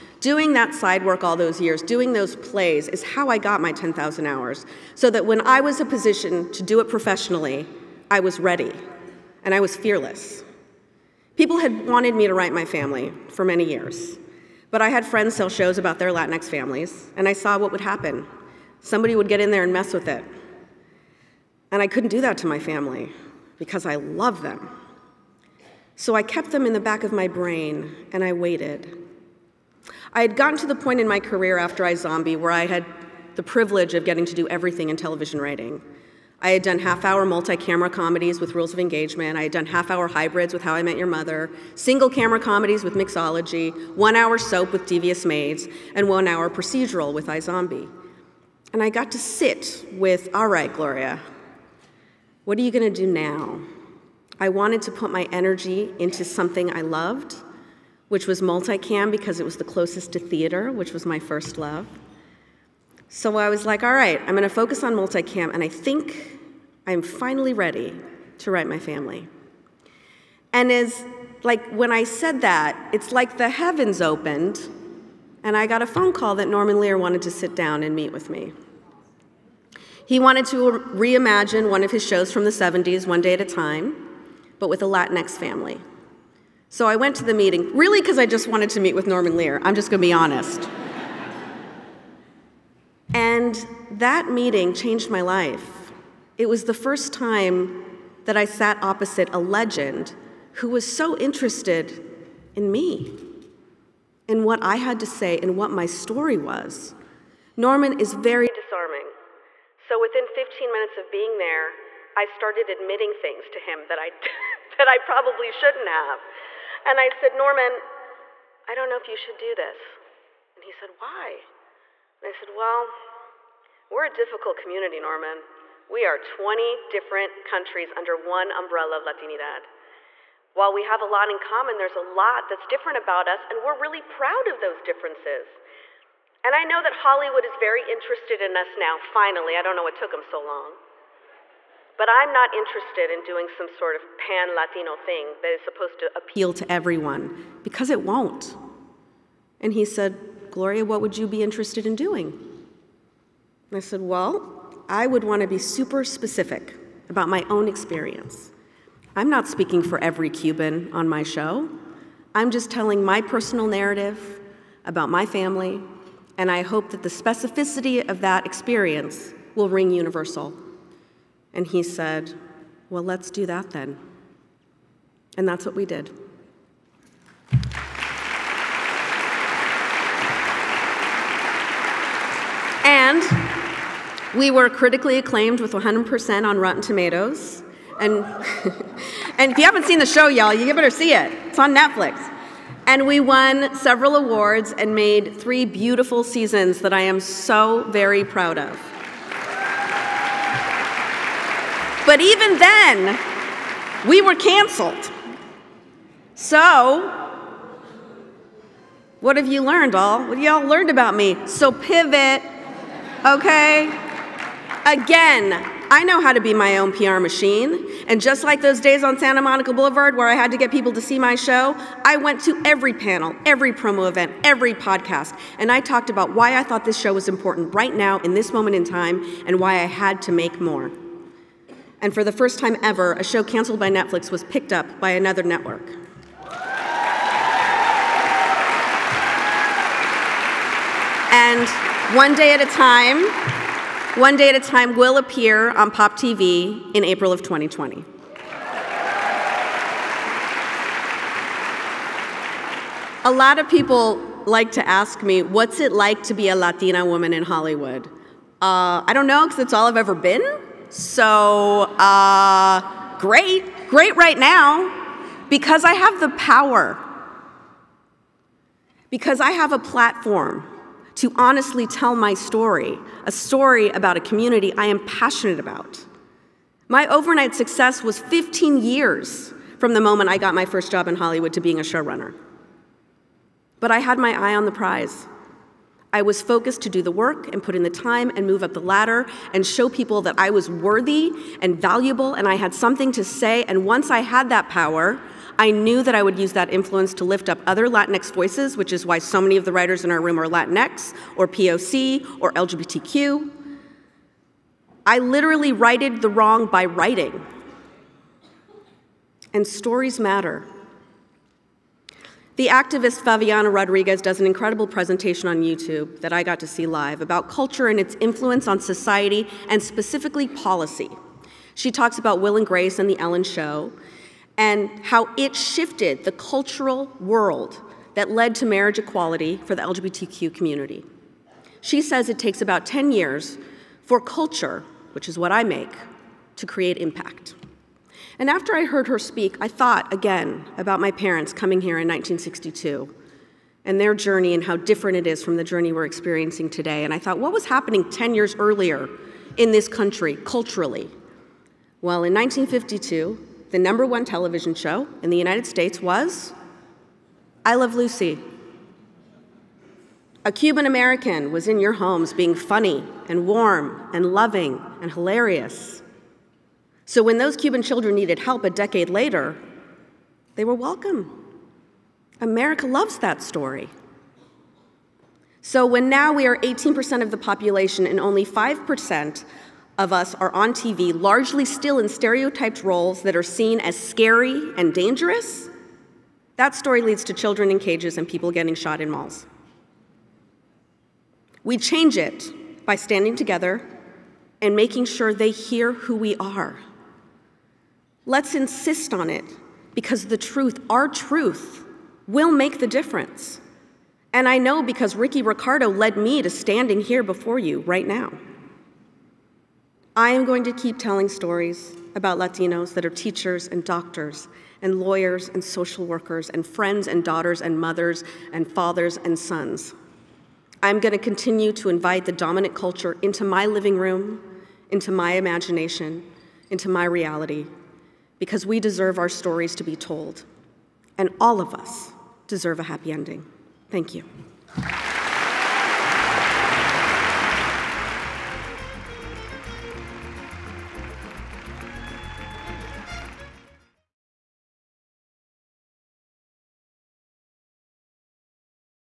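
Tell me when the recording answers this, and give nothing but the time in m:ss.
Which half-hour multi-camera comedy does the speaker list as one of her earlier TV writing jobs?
0:38.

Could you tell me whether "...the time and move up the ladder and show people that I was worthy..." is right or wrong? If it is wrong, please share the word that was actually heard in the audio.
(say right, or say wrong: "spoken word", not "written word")
right.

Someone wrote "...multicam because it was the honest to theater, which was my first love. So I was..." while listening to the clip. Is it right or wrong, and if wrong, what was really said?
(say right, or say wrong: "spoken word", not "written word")
wrong: "closest", not "honest".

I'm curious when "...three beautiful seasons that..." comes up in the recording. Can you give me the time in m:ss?
3:15.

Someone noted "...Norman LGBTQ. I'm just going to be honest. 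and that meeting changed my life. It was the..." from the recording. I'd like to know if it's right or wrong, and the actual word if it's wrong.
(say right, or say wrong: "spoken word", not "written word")
wrong: "Lear", not "LGBTQ".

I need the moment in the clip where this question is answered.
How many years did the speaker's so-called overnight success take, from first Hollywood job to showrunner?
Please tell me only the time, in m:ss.
4:38.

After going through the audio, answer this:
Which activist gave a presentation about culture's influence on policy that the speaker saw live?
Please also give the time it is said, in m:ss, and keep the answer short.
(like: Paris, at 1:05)
Favianna Rodriguez, at 5:13.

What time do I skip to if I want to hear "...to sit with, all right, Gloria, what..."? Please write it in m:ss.
0:49.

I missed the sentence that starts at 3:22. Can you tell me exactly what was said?
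But even then, we were canceled.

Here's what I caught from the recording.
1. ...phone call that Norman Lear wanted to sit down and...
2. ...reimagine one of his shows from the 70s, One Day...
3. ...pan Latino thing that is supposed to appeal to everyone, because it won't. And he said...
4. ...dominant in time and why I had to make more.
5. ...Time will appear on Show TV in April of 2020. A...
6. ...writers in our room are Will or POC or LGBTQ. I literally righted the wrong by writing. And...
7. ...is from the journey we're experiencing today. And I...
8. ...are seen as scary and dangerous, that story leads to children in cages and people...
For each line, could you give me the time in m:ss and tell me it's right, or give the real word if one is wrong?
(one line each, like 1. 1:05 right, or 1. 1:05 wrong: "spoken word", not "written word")
1. 1:15 right
2. 1:20 right
3. 2:24 right
4. 3:48 wrong: "moment", not "dominant"
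5. 4:04 wrong: "Pop", not "Show"
6. 4:59 wrong: "Latinx", not "Will"
7. 5:45 right
8. 6:23 right.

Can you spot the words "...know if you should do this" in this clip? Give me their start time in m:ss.
1:58.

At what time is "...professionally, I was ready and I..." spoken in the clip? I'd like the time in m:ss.
0:06.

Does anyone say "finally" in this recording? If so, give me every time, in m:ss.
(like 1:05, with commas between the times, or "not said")
1:07, 2:18.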